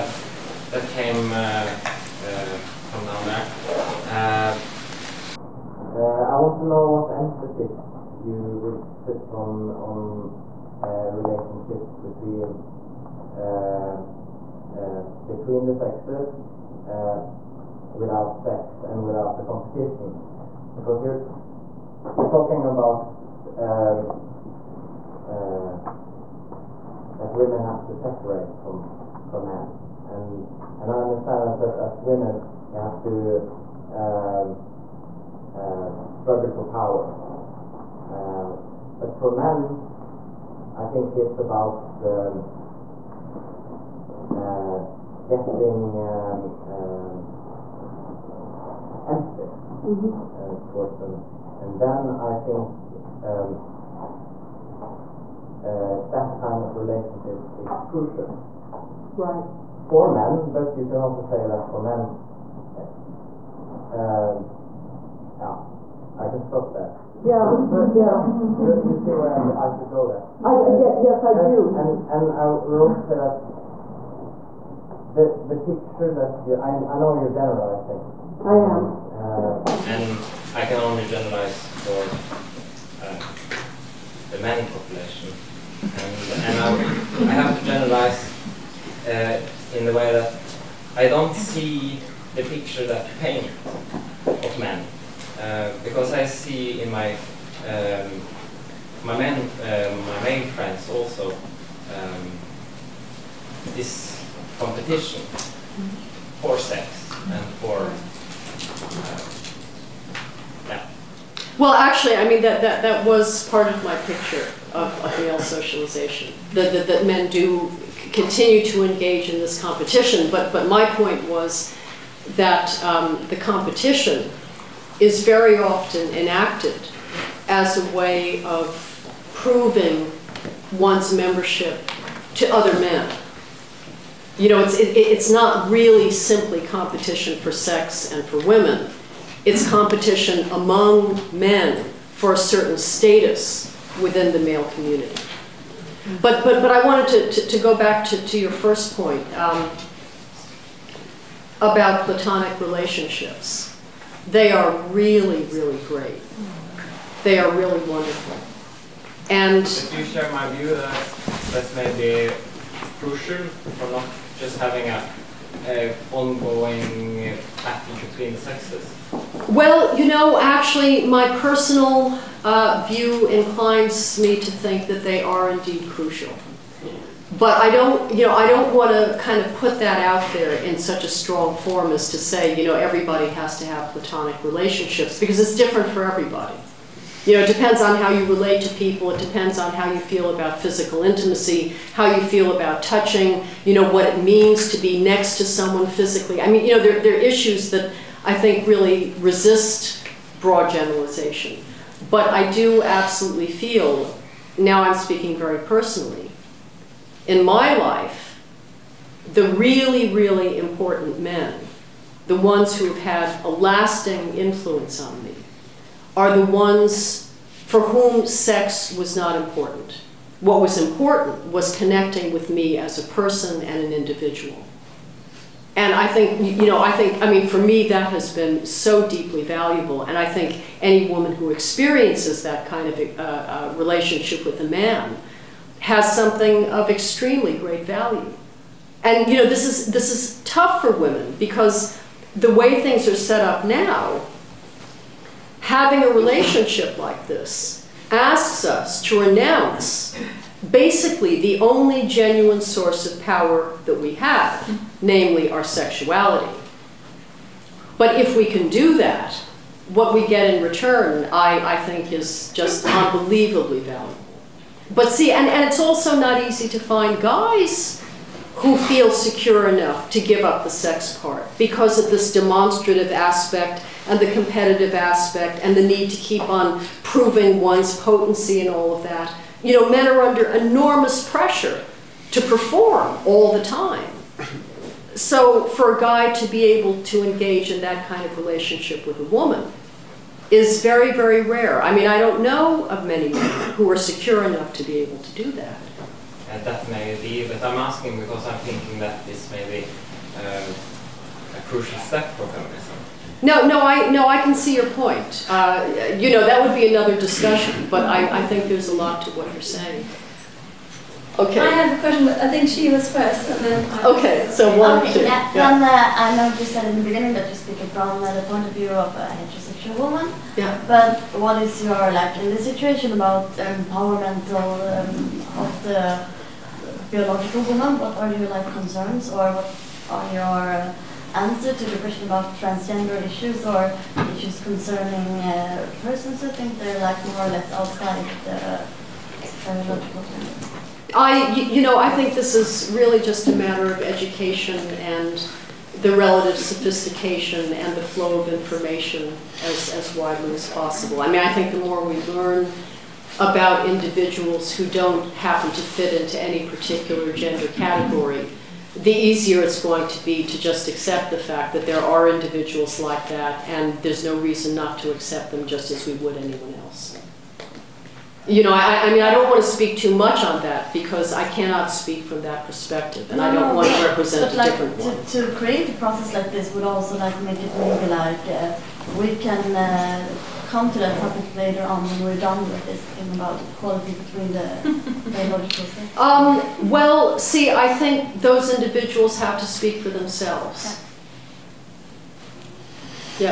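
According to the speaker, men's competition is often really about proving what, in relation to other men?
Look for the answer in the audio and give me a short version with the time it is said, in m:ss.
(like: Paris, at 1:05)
membership, at 2:11.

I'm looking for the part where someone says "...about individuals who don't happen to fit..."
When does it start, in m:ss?
5:53.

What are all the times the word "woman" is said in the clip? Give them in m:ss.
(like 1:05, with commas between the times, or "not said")
3:51, 4:49, 5:19, 5:27.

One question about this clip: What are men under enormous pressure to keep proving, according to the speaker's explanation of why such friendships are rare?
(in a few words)
potency.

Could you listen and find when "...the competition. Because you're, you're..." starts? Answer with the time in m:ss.
0:19.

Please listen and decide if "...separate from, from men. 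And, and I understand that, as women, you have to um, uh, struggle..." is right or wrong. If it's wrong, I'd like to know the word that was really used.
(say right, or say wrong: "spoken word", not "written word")
right.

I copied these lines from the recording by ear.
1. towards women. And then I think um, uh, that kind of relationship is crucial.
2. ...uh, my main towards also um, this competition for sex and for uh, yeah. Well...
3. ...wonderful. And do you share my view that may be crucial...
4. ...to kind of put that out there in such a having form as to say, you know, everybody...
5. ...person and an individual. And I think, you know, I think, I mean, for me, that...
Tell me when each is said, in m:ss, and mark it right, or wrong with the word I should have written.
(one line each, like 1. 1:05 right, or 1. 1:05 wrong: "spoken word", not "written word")
1. 0:50 right
2. 1:39 wrong: "friends", not "towards"
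3. 2:37 right
4. 2:58 wrong: "strong", not "having"
5. 3:43 right.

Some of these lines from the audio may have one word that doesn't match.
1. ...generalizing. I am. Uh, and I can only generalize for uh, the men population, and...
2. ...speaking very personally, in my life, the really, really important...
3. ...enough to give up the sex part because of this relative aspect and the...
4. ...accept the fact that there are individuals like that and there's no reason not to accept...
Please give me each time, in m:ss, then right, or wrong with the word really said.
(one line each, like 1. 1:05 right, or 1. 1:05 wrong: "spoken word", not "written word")
1. 1:17 right
2. 3:24 right
3. 4:29 wrong: "demonstrative", not "relative"
4. 6:00 right.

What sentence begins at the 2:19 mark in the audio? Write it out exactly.
It's competition among men for a certain status within the male community.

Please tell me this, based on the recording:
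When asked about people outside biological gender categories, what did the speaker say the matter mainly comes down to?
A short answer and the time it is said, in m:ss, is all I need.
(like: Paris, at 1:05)
education, at 5:44.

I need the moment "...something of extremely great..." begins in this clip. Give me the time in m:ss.
3:56.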